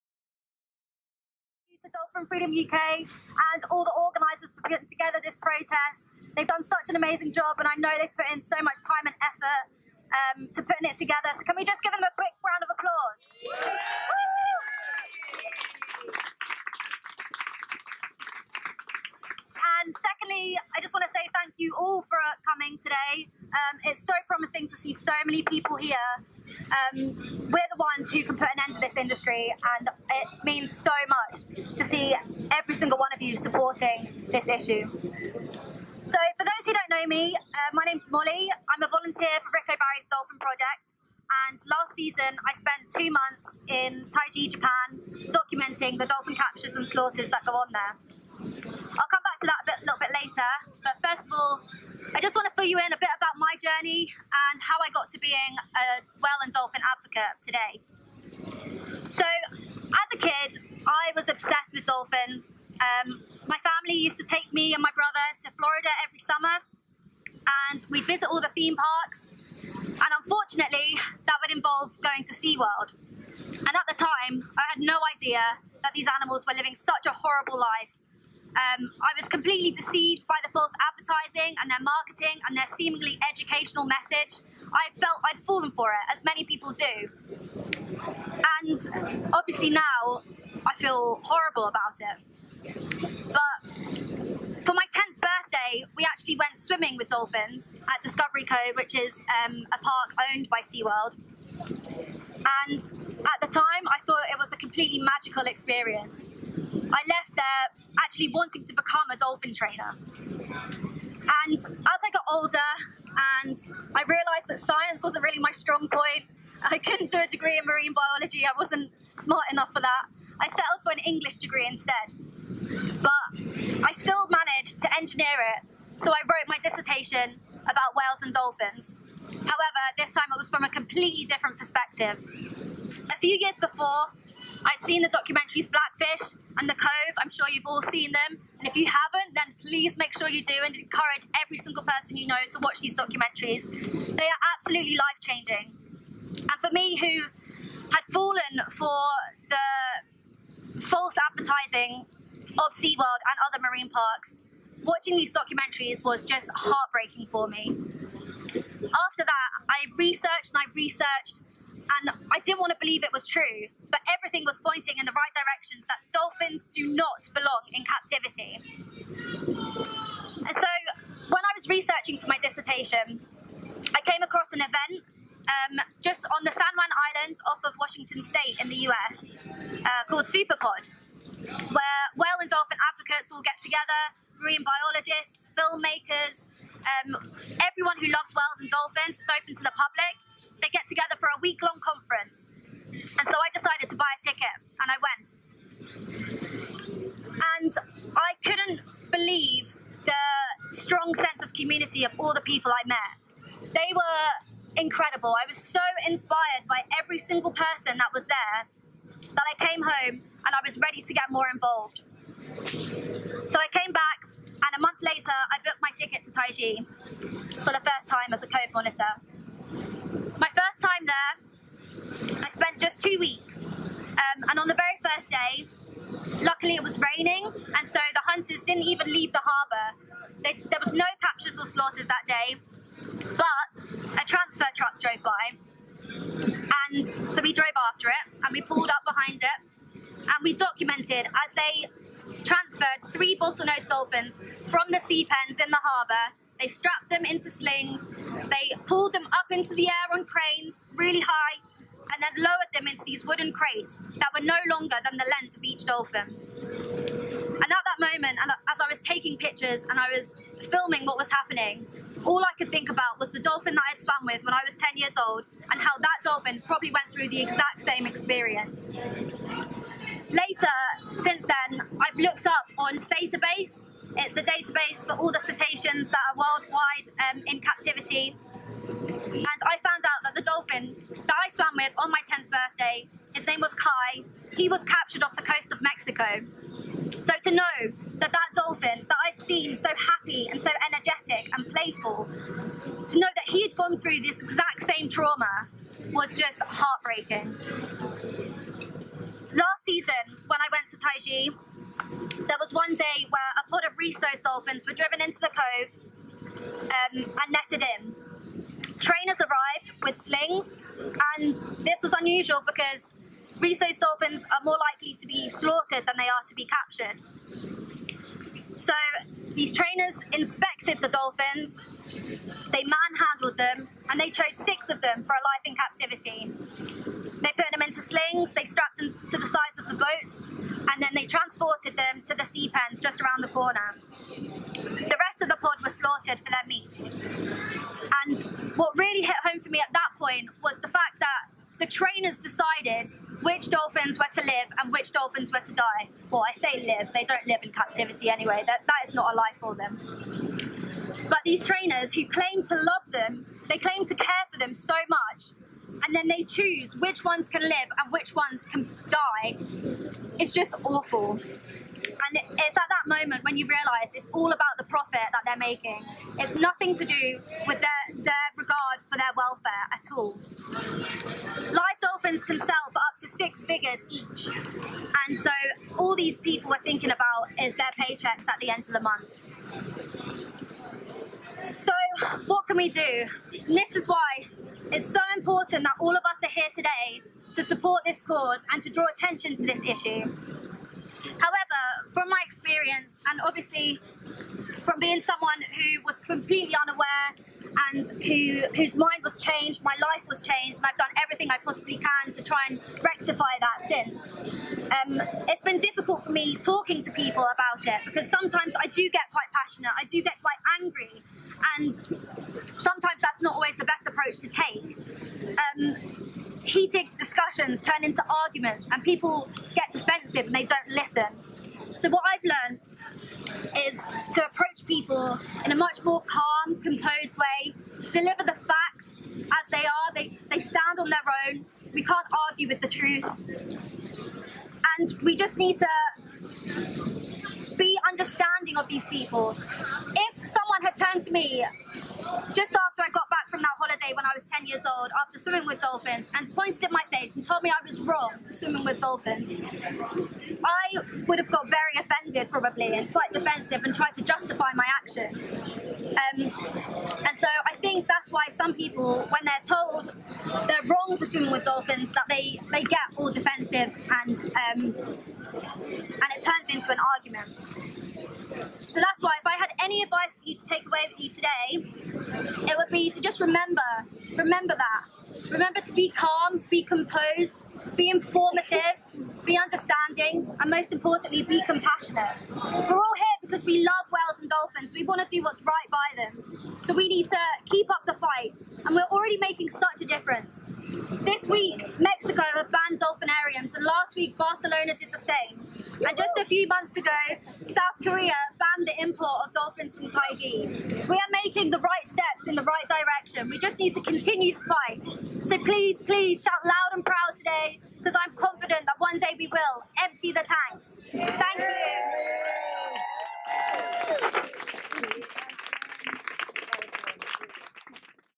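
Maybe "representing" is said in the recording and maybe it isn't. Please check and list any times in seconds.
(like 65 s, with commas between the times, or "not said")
not said.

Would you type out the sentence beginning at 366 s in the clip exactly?
It's nothing to do with their, their regard for their welfare at all.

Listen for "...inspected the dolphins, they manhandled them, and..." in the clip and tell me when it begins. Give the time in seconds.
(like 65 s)
320 s.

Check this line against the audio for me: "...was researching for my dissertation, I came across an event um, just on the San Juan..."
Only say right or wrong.
right.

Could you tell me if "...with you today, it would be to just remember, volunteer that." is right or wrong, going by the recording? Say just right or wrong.
wrong.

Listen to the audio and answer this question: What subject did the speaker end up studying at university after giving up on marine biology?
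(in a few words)
English.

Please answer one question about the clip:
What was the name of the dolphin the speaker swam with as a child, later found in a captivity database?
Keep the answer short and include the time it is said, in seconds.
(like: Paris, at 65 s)
Kai, at 283 s.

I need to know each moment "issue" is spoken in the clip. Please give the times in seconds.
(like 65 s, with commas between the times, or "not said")
34 s, 389 s.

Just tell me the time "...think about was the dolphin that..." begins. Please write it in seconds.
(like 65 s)
262 s.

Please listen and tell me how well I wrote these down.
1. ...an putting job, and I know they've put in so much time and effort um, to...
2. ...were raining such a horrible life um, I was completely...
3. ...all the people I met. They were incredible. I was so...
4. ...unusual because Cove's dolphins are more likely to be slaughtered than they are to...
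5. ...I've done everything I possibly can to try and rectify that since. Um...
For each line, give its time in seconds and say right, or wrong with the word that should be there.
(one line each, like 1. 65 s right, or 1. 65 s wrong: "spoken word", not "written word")
1. 6 s wrong: "amazing", not "putting"
2. 76 s wrong: "living", not "raining"
3. 202 s right
4. 312 s wrong: "Risso", not "Cove"
5. 400 s right.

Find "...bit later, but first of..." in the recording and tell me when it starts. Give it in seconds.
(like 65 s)
50 s.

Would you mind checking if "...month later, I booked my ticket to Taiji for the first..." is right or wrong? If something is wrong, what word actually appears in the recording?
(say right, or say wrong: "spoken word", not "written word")
right.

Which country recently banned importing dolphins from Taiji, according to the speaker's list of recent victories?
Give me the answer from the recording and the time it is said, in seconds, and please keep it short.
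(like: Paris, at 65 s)
South Korea, at 497 s.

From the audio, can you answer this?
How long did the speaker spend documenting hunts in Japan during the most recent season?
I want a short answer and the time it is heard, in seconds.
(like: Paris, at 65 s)
2 months, at 42 s.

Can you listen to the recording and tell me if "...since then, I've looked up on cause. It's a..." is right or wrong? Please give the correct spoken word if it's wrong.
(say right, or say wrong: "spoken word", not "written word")
wrong: "database", not "cause".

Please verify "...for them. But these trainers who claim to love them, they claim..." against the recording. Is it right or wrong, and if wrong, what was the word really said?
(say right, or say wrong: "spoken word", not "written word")
right.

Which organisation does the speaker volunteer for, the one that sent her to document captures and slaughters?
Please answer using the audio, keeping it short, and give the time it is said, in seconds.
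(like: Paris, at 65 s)
Ric O'Barry's Dolphin Project, at 39 s.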